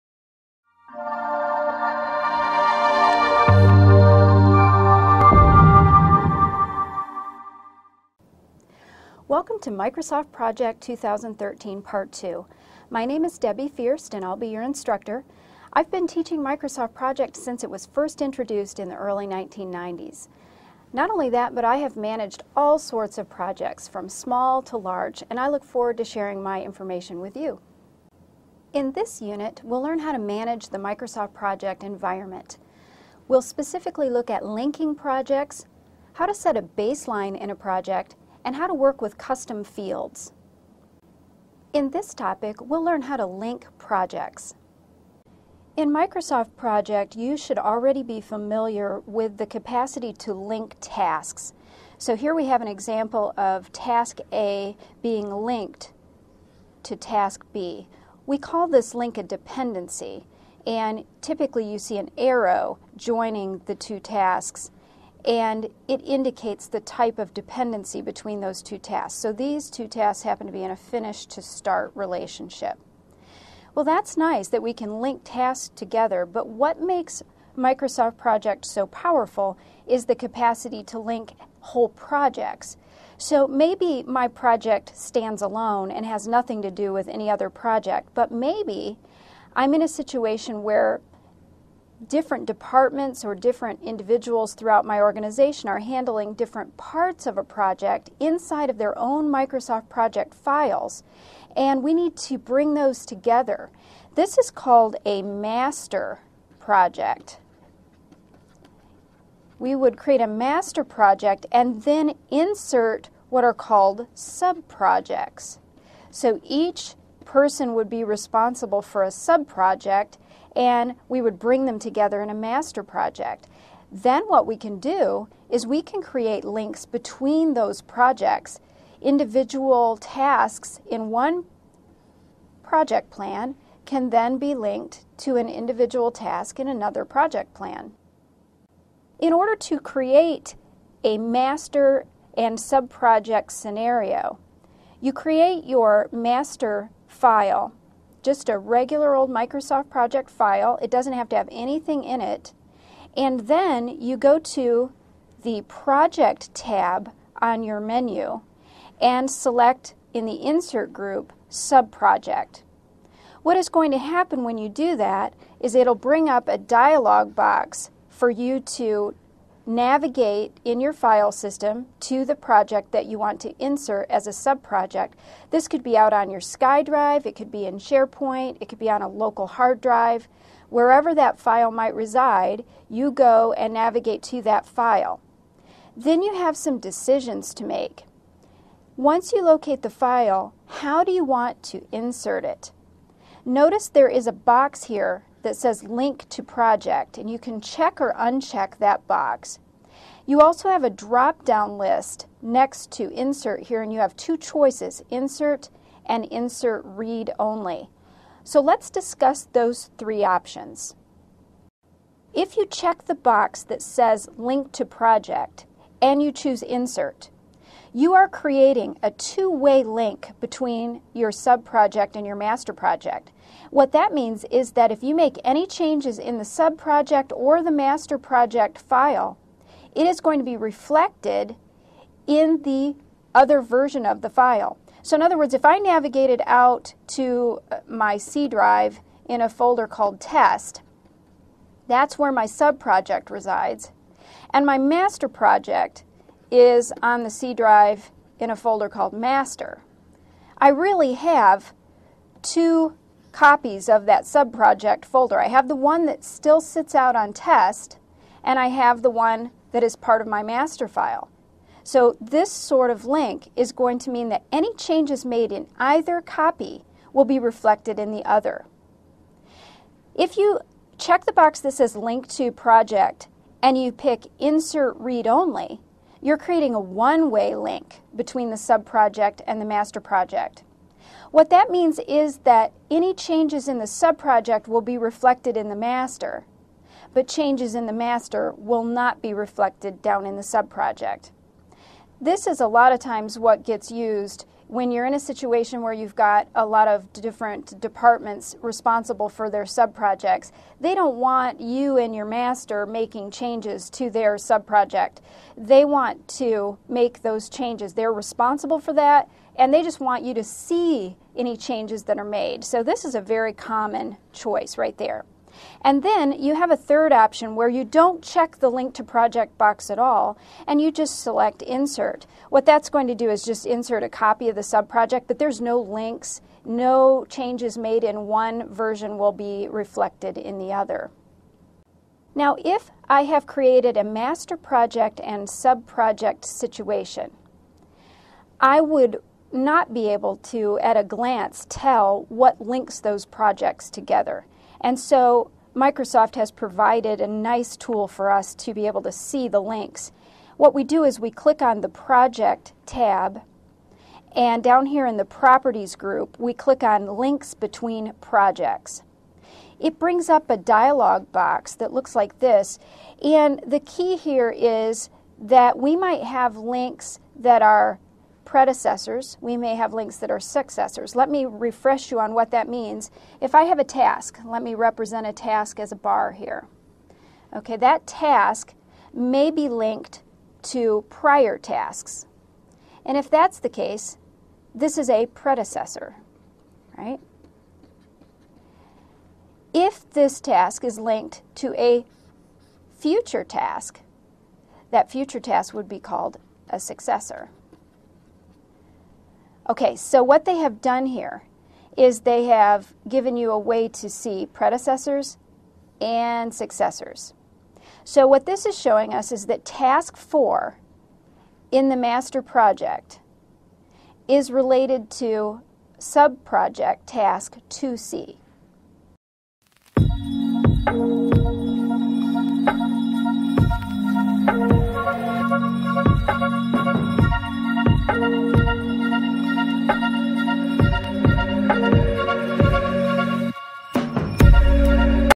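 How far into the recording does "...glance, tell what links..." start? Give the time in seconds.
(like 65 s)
341 s.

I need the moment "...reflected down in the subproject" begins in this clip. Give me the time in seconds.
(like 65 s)
289 s.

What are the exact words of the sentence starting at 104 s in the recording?
This is called a master project.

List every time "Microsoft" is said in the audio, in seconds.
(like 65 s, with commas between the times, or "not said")
9 s, 16 s, 30 s, 45 s, 77 s, 99 s, 149 s, 345 s.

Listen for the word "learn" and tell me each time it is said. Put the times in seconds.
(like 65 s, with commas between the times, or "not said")
29 s, 42 s.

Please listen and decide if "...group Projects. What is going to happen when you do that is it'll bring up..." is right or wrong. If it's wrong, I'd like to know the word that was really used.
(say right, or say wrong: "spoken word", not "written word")
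wrong: "Subproject", not "Projects".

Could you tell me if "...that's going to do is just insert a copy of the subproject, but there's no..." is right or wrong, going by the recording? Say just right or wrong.
right.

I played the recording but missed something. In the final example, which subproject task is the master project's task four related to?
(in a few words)
2C.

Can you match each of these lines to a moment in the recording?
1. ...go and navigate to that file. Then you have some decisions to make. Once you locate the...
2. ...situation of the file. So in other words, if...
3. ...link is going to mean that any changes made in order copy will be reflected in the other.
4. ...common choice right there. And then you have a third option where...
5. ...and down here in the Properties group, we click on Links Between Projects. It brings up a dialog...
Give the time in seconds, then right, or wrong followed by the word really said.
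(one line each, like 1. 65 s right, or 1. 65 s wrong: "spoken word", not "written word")
1. 183 s right
2. 233 s wrong: "version", not "situation"
3. 263 s wrong: "either", not "order"
4. 313 s right
5. 354 s right.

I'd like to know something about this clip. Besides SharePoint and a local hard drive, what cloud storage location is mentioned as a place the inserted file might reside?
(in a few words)
SkyDrive.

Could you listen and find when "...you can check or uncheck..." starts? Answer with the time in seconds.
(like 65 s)
197 s.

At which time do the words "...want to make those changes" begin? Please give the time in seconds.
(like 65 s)
305 s.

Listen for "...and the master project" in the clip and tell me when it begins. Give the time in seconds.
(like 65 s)
279 s.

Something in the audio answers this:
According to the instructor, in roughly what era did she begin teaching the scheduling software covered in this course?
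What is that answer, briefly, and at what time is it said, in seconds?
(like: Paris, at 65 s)
early 1990s, at 18 s.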